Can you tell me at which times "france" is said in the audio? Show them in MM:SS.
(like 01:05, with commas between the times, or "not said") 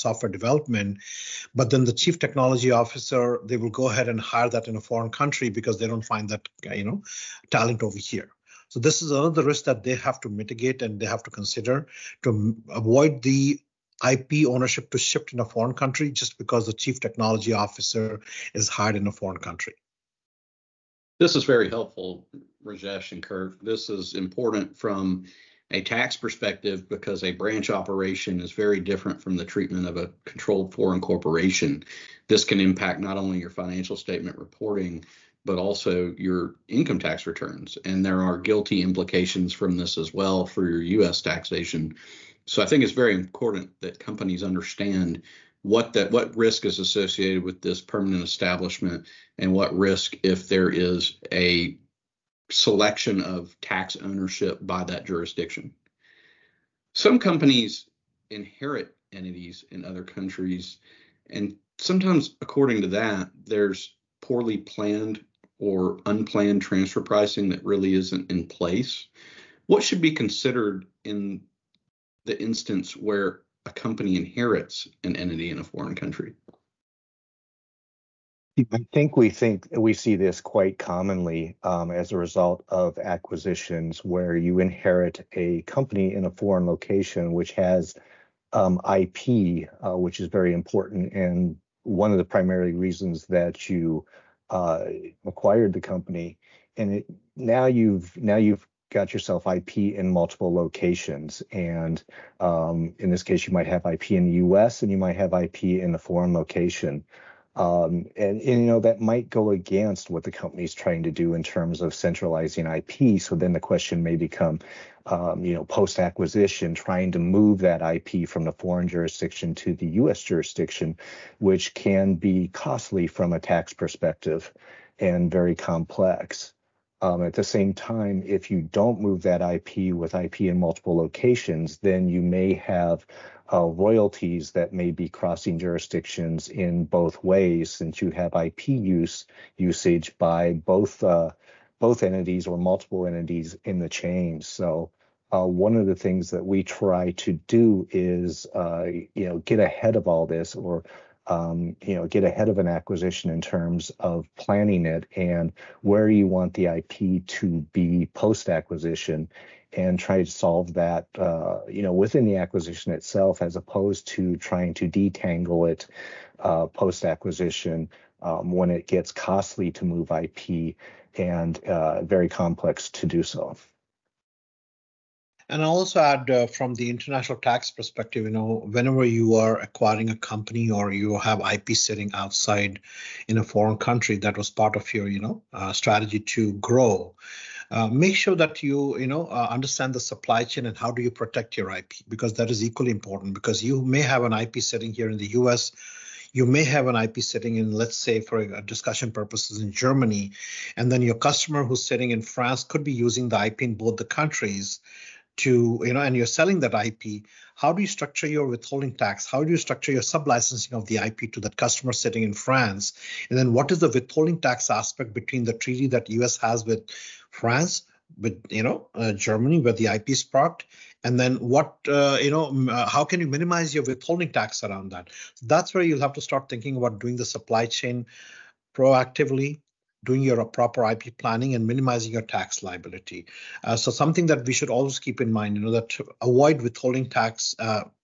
03:22, 03:32, 03:37.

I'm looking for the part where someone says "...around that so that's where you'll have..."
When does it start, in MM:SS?
03:44.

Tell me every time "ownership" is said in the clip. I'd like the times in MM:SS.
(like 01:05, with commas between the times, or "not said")
00:14, 00:53.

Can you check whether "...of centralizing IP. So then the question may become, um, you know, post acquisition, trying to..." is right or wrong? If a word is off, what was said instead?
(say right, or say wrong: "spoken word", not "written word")
right.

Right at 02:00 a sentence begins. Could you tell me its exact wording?
jurisdiction, which can be costly from a tax perspective and very complex.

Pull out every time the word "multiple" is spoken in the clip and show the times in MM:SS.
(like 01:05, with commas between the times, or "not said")
01:40, 02:10, 02:22.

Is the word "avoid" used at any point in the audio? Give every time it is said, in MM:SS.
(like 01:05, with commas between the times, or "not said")
00:12, 03:56.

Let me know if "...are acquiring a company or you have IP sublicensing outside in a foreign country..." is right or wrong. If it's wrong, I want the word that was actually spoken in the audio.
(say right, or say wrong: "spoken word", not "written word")
wrong: "sitting", not "sublicensing".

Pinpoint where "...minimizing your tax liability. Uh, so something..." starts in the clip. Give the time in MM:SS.
03:51.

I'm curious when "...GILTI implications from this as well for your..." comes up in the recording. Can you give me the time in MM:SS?
00:38.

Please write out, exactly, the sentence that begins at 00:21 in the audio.
This is very helpful, Rajesh and Kurt.